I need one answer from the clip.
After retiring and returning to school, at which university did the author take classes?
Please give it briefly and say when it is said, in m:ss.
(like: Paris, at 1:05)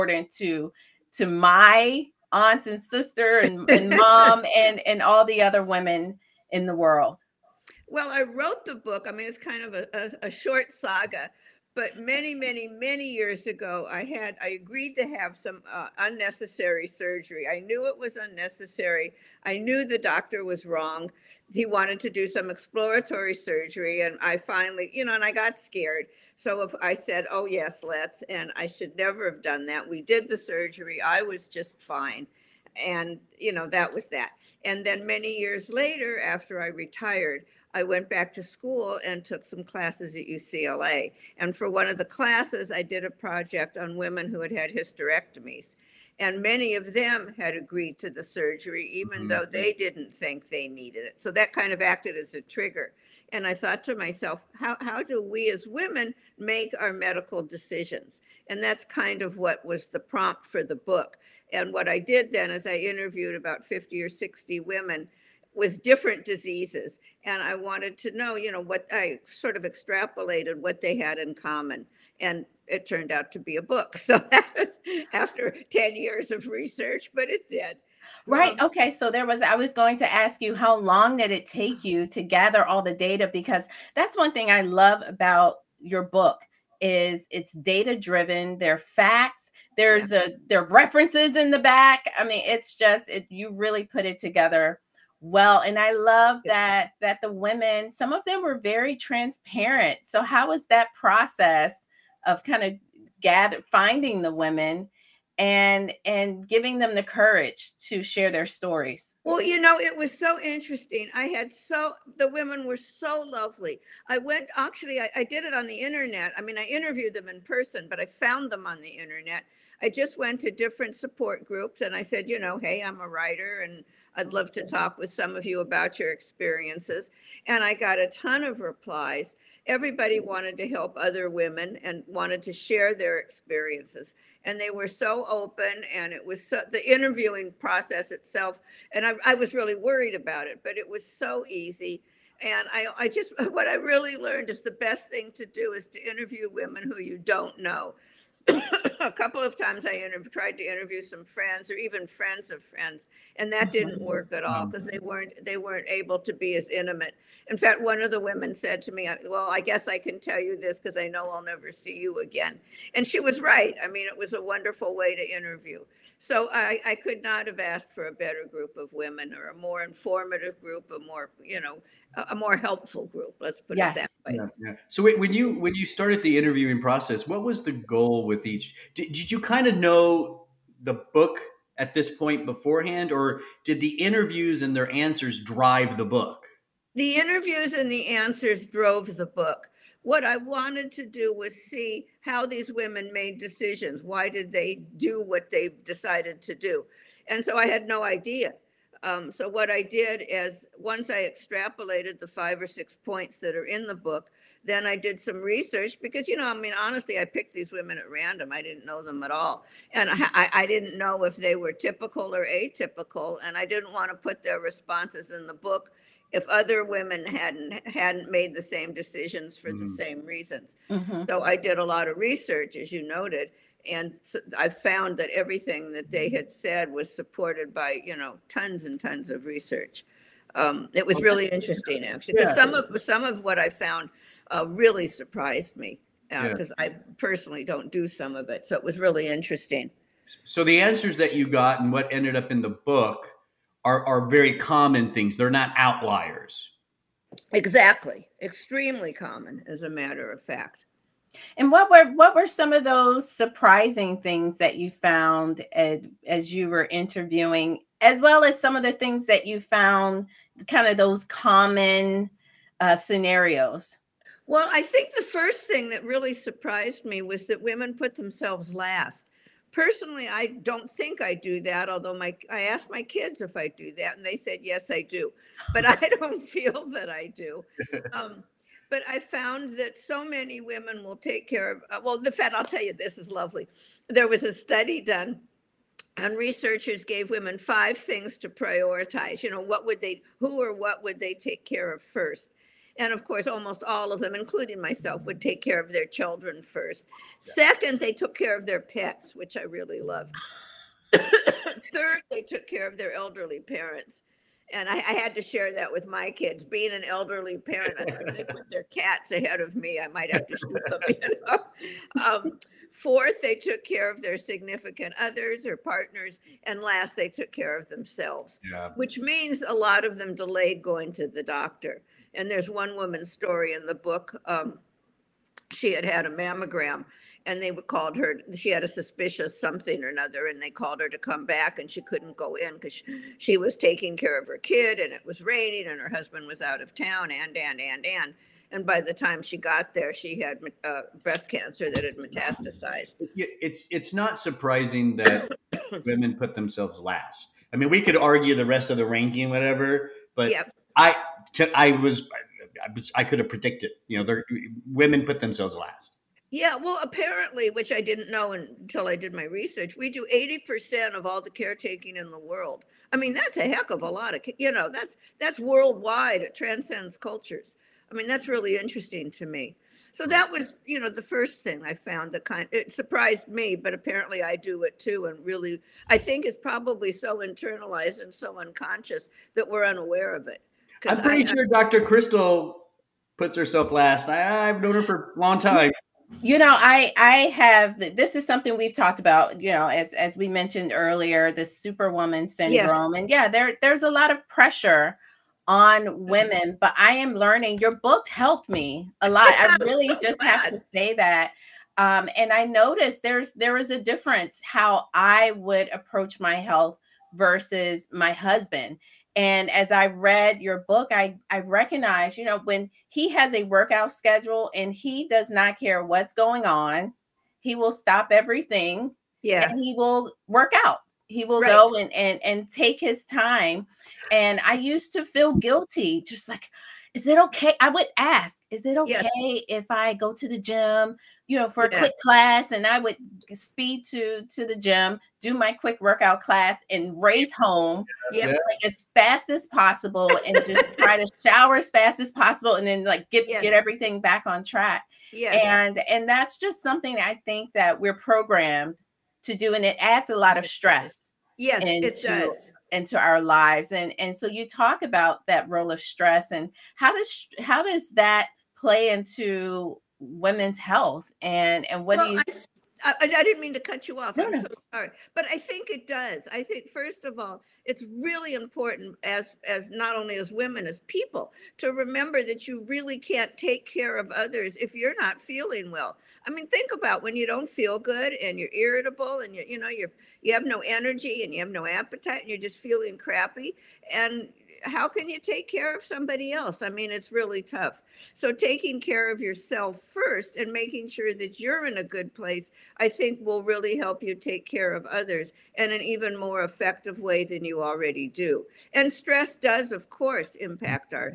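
UCLA, at 0:40.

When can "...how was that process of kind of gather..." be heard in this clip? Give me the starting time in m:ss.
1:40.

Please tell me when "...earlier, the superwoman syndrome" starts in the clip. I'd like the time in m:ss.
6:30.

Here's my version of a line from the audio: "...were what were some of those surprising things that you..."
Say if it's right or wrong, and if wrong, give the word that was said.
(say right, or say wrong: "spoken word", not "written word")
right.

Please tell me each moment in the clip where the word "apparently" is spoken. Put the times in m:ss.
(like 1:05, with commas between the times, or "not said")
5:57, 6:13.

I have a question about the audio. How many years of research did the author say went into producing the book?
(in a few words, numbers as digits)
10.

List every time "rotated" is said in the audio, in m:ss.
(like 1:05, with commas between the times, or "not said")
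not said.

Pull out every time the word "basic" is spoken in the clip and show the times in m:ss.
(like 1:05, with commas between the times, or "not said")
not said.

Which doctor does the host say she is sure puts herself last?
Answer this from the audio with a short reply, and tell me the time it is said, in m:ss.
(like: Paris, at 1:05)
Dr. Crystal, at 6:21.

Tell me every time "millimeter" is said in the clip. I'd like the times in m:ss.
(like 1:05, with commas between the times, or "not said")
not said.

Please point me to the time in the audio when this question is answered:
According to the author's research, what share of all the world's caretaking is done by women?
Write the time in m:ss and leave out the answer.
6:00.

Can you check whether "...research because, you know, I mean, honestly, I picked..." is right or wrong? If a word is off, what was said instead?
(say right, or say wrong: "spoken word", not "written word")
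right.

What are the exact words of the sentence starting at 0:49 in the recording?
though they didn't think they needed it.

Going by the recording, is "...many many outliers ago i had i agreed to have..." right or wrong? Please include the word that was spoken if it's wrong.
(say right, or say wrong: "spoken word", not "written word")
wrong: "years", not "outliers".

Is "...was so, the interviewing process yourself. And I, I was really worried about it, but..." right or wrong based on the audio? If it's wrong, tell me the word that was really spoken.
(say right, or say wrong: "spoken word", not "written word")
wrong: "itself", not "yourself".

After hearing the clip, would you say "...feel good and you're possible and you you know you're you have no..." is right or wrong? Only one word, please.
wrong.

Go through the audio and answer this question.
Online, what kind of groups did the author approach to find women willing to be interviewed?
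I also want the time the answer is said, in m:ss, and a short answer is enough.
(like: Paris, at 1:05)
Support groups, at 2:00.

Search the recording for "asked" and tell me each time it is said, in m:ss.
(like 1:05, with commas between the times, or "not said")
2:47, 4:32.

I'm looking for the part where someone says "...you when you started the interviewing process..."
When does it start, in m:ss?
2:55.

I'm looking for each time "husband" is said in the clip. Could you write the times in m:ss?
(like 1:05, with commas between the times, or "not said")
5:36, 6:48.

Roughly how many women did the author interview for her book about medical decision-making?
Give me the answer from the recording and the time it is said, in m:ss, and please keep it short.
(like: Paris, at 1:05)
50 or 60, at 1:03.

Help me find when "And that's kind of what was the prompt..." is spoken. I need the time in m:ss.
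0:58.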